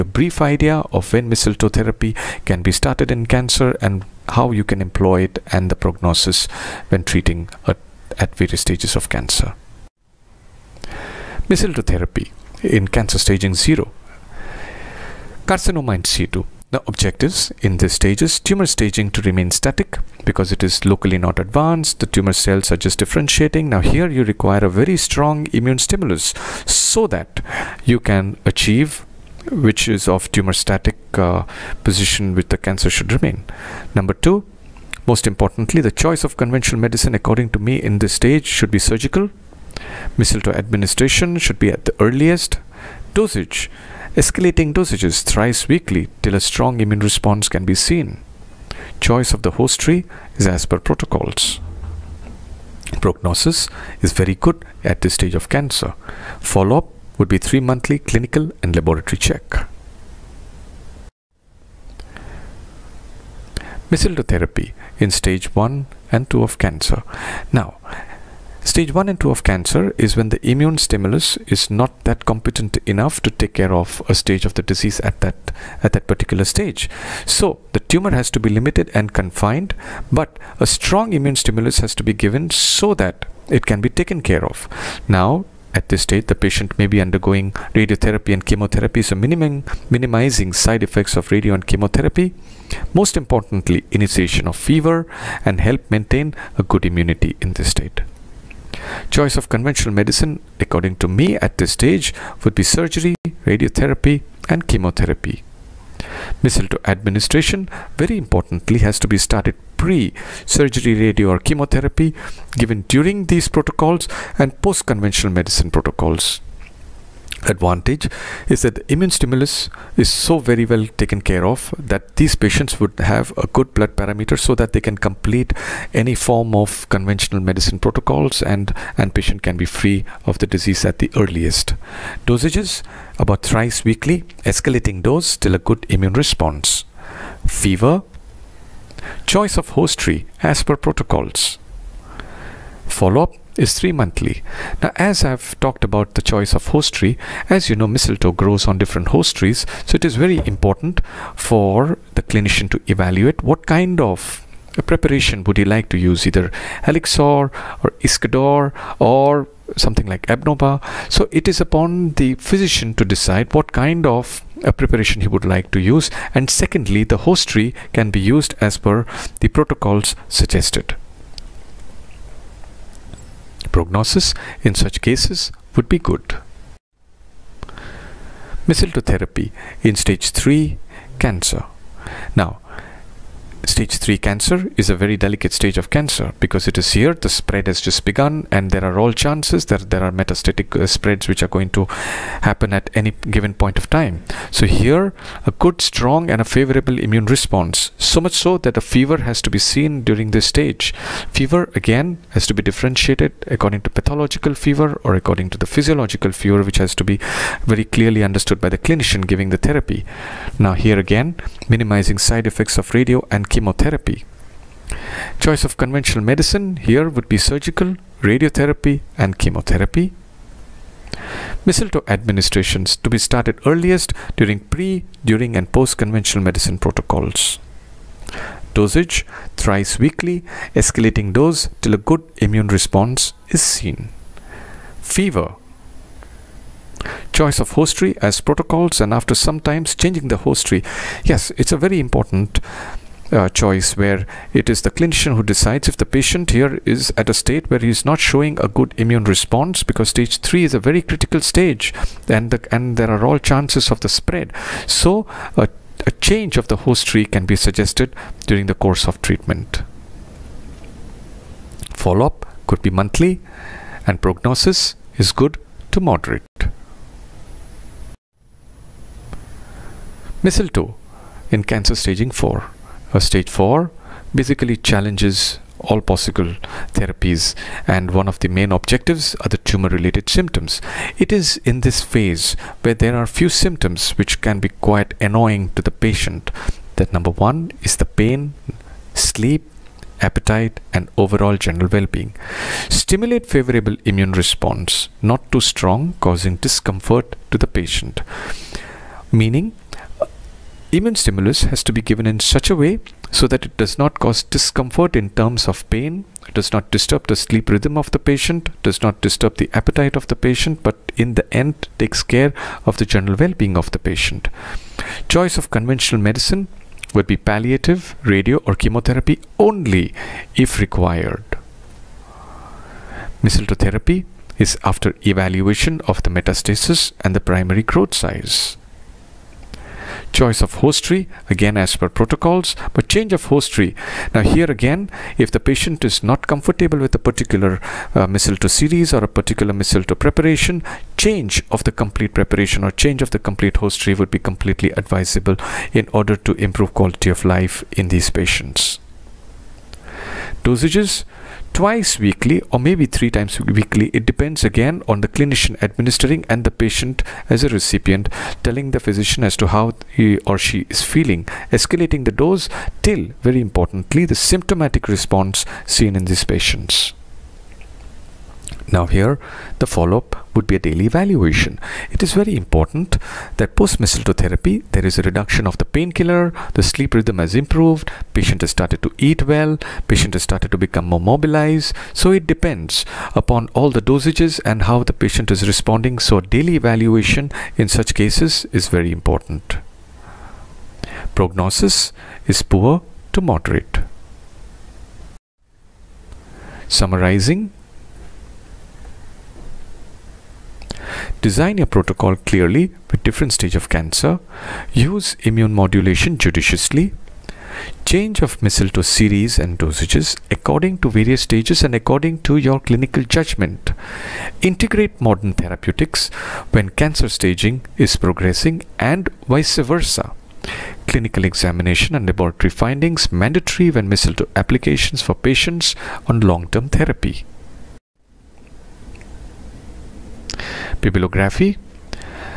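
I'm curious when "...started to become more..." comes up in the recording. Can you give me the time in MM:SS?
06:20.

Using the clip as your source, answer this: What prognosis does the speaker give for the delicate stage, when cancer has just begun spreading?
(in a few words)
Good to moderate.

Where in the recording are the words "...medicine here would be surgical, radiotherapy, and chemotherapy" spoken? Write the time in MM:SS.
03:36.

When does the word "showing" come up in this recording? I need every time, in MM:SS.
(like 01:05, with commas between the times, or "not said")
04:08.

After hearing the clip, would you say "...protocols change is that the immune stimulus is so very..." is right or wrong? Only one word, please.
wrong.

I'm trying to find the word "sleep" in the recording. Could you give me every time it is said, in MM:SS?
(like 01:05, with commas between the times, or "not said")
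04:49, 05:07, 06:16.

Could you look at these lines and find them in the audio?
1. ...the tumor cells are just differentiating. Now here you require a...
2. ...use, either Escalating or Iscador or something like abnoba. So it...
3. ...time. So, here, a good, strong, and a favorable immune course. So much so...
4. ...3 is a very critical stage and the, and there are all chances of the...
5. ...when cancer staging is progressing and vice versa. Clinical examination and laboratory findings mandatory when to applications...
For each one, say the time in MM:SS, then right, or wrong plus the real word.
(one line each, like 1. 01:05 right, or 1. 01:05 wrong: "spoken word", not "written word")
1. 00:21 right
2. 02:35 wrong: "Helixor", not "Escalating"
3. 03:13 wrong: "response", not "course"
4. 04:10 right
5. 06:56 right.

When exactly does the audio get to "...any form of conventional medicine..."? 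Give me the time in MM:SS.
02:05.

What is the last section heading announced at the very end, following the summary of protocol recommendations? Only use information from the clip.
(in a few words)
Bibliography.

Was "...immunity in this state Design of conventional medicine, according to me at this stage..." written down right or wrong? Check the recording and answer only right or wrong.
wrong.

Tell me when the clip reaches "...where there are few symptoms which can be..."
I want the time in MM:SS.
04:42.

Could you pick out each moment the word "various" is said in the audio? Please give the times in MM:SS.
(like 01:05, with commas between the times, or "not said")
00:08, 06:51.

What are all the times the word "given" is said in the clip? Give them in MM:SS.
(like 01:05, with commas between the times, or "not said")
01:22, 01:52, 03:13, 05:02.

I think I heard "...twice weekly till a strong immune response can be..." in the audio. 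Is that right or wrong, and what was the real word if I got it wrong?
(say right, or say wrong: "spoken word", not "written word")
wrong: "thrice", not "twice".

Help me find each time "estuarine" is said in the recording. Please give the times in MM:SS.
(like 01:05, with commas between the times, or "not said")
not said.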